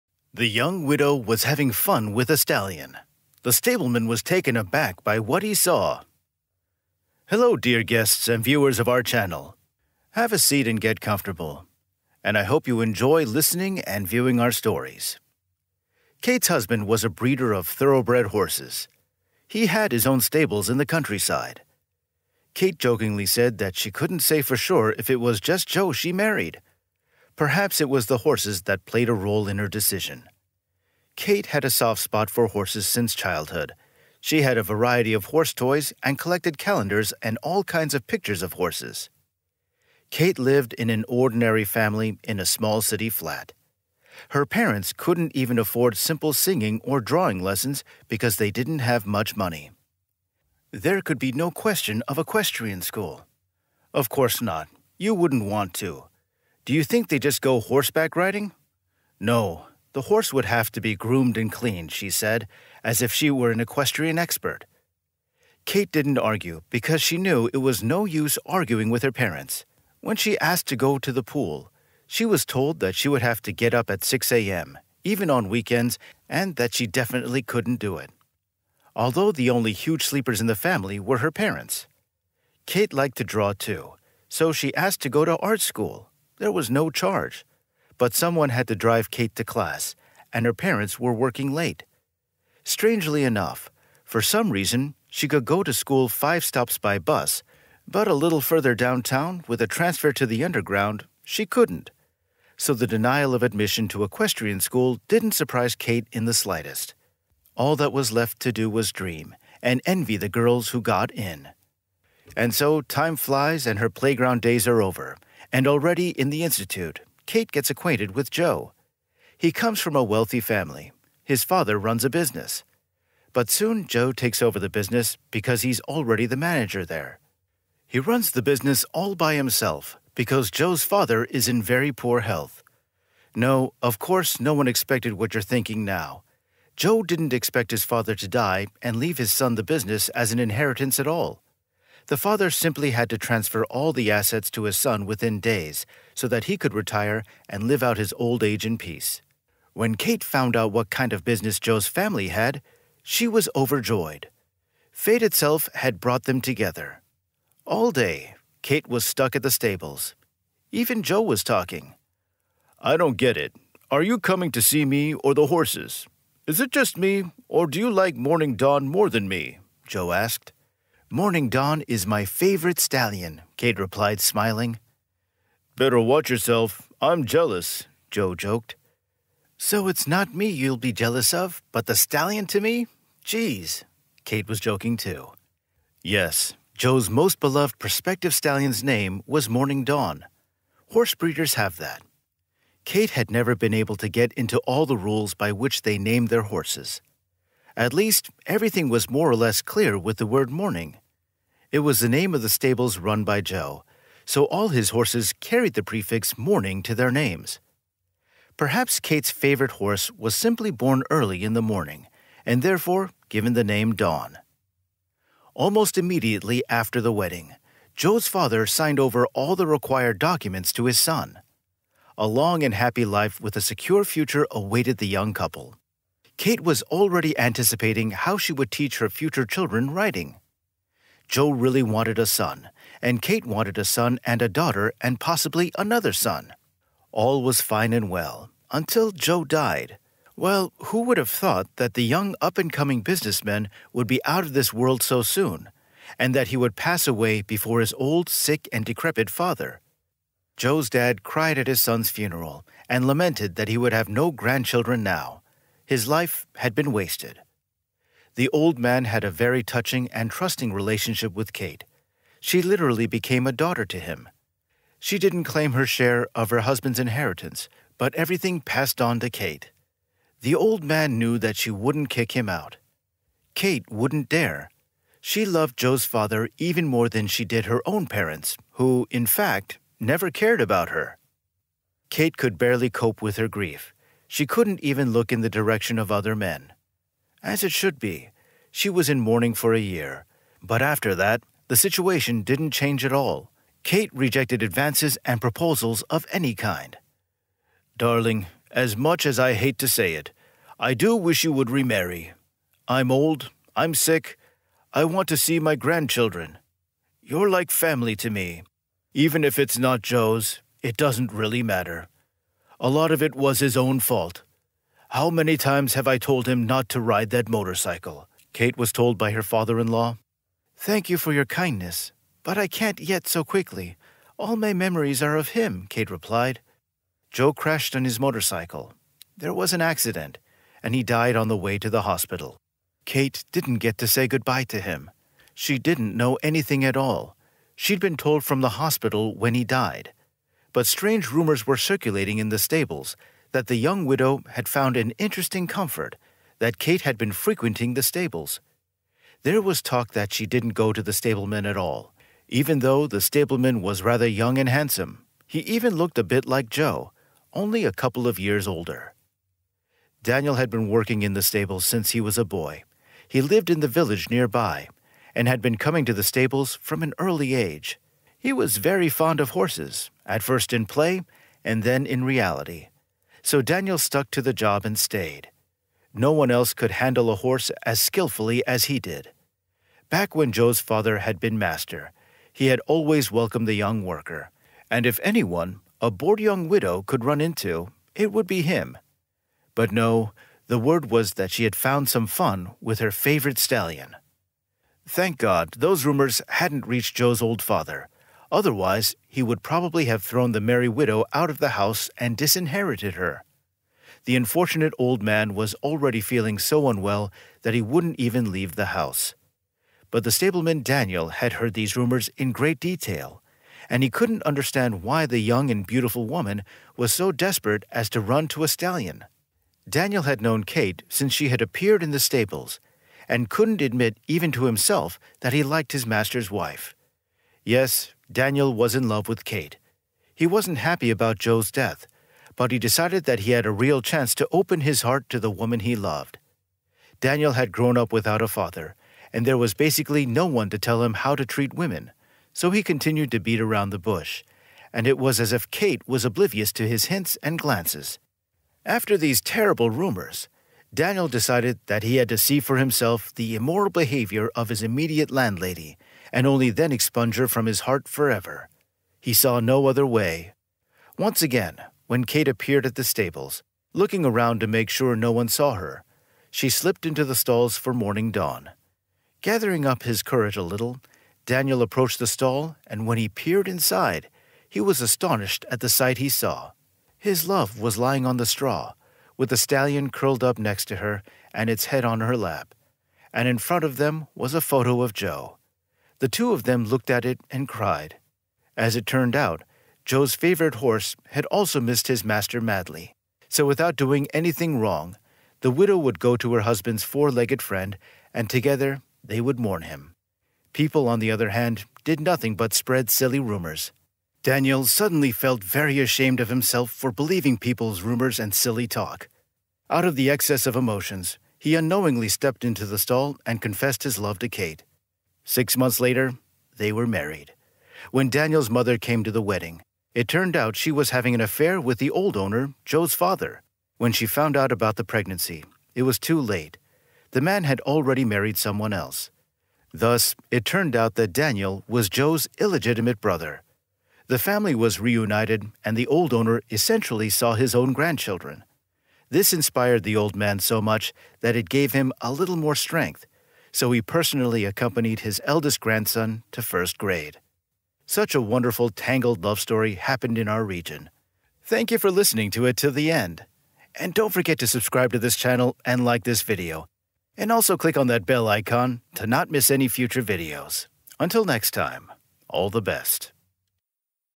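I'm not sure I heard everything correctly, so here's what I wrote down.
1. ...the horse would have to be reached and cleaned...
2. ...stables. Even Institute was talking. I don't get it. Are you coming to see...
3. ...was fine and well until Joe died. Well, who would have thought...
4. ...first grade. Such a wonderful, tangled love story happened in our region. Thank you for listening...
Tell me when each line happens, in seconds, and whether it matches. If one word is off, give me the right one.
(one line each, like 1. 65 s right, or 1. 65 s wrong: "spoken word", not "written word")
1. 59 s wrong: "groomed", not "reached"
2. 159 s wrong: "Joe", not "Institute"
3. 237 s right
4. 546 s right.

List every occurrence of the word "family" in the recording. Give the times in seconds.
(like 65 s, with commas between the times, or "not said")
41 s, 80 s, 120 s, 151 s, 307 s, 534 s.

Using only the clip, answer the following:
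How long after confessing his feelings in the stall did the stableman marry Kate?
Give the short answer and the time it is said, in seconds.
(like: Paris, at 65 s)
6 months, at 515 s.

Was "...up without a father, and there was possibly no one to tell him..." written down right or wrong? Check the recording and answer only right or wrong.
wrong.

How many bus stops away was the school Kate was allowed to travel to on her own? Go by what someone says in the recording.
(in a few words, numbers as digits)
5.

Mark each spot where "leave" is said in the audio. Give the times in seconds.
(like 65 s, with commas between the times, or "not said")
138 s, 408 s.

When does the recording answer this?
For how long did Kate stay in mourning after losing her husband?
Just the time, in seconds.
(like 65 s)
289 s.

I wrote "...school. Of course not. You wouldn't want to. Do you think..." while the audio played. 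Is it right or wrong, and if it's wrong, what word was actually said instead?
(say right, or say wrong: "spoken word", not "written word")
right.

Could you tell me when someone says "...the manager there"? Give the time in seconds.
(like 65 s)
126 s.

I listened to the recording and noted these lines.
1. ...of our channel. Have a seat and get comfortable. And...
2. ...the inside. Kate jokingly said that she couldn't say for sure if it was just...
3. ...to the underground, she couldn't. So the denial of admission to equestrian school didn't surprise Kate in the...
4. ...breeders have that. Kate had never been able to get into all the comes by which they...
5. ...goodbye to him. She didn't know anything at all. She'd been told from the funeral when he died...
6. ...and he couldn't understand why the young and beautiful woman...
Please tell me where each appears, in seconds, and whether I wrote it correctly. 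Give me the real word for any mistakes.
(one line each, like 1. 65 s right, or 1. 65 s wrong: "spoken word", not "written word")
1. 8 s right
2. 20 s wrong: "countryside", not "inside"
3. 100 s right
4. 191 s wrong: "rules", not "comes"
5. 334 s wrong: "hospital", not "funeral"
6. 413 s right.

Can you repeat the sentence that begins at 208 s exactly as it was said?
Perhaps Kate's favorite horse was simply born early in the morning, and therefore given the name Dawn.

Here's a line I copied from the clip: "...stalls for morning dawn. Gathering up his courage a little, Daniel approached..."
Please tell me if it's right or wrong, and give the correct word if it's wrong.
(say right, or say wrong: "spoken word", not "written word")
right.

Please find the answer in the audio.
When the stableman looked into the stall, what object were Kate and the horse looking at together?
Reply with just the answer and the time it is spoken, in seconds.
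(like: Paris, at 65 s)
A photo of Joe, at 484 s.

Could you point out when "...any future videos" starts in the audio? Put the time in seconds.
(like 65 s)
559 s.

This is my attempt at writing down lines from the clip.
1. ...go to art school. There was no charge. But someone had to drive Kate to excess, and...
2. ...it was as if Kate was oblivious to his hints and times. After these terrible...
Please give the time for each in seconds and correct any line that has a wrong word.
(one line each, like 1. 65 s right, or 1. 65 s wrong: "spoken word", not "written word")
1. 85 s wrong: "class", not "excess"
2. 445 s wrong: "glances", not "times".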